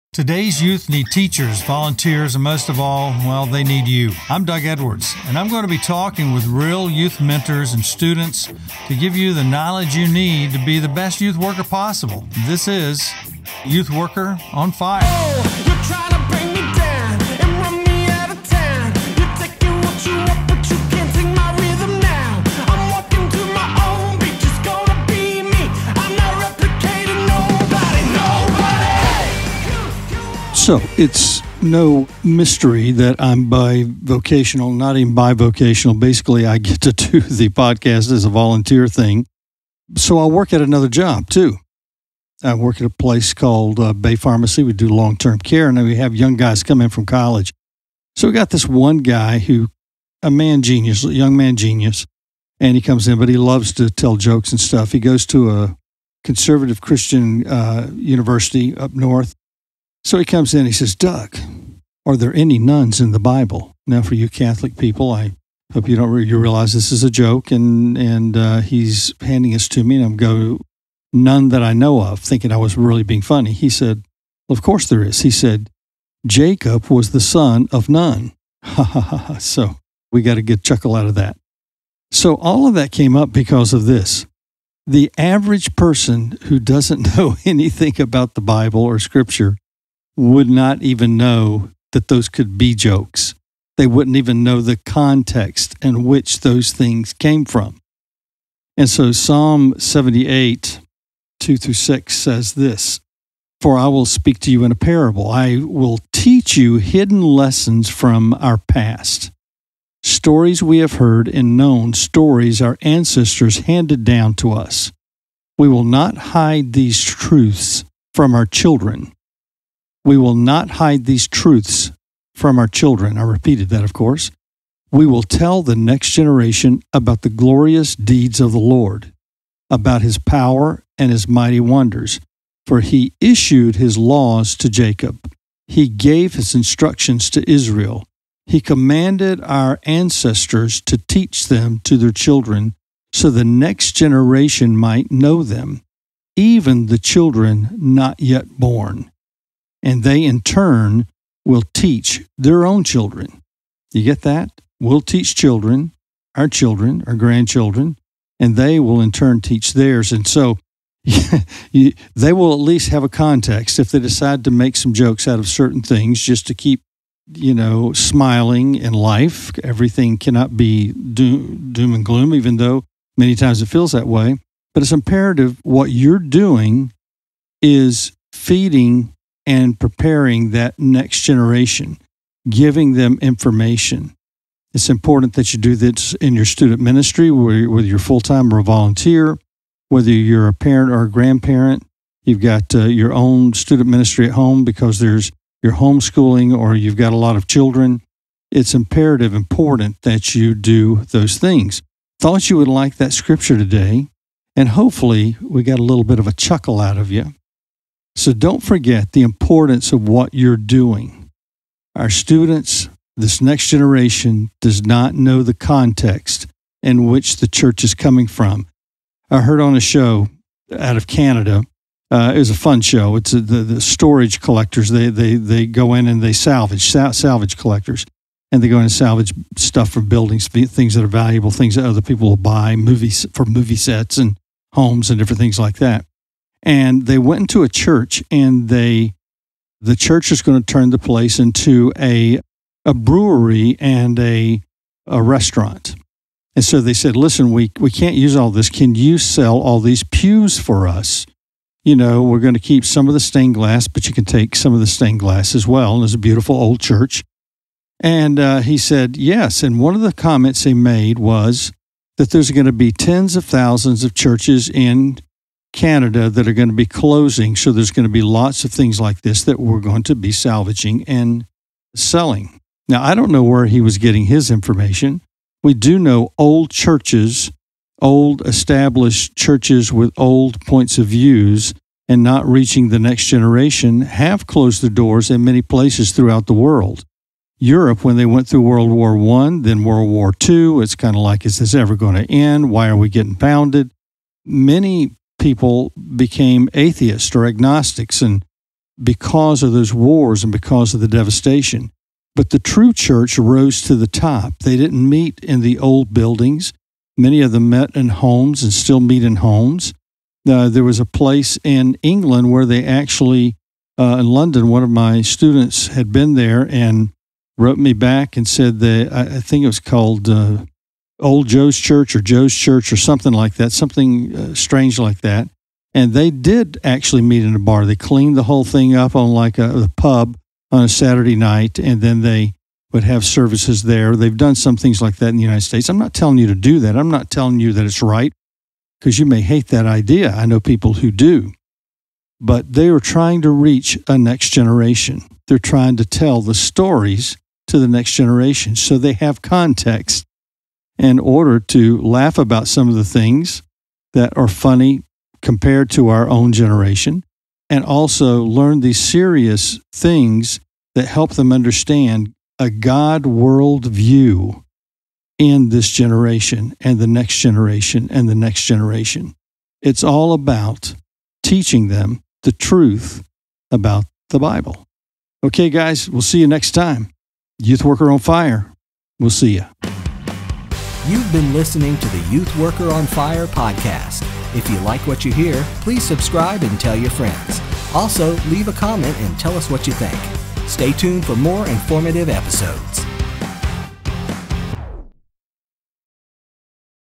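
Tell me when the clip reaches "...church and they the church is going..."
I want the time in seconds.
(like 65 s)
237 s.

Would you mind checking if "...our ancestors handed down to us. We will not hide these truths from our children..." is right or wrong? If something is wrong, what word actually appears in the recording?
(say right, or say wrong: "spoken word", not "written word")
right.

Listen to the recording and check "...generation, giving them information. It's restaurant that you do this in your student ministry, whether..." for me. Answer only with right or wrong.
wrong.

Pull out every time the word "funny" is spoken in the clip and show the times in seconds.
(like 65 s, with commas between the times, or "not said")
73 s, 354 s.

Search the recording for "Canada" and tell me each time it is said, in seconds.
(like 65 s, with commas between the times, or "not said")
221 s, 265 s.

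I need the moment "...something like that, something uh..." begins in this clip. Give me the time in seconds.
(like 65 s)
322 s.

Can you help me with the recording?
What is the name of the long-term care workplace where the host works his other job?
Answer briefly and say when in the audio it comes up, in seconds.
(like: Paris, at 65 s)
Bay Pharmacy, at 43 s.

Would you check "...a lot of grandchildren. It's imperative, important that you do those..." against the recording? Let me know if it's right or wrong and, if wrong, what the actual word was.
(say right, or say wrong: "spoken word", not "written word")
wrong: "children", not "grandchildren".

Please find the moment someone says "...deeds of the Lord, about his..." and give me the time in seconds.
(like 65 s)
127 s.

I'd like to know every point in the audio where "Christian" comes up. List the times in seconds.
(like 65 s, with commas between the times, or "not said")
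56 s.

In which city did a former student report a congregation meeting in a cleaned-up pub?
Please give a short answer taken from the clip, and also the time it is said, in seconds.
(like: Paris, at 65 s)
London, at 314 s.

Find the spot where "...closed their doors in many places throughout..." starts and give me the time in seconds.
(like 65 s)
284 s.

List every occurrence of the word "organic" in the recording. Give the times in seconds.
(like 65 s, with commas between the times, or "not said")
not said.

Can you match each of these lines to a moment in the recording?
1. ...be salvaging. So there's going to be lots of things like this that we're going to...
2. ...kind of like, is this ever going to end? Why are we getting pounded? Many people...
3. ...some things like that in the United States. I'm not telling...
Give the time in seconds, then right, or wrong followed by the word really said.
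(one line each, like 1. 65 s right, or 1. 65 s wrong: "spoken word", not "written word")
1. 266 s wrong: "closing", not "salvaging"
2. 290 s right
3. 334 s right.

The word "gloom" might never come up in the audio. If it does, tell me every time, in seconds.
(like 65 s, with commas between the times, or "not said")
172 s.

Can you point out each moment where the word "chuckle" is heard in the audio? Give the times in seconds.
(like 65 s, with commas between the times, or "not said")
80 s, 206 s.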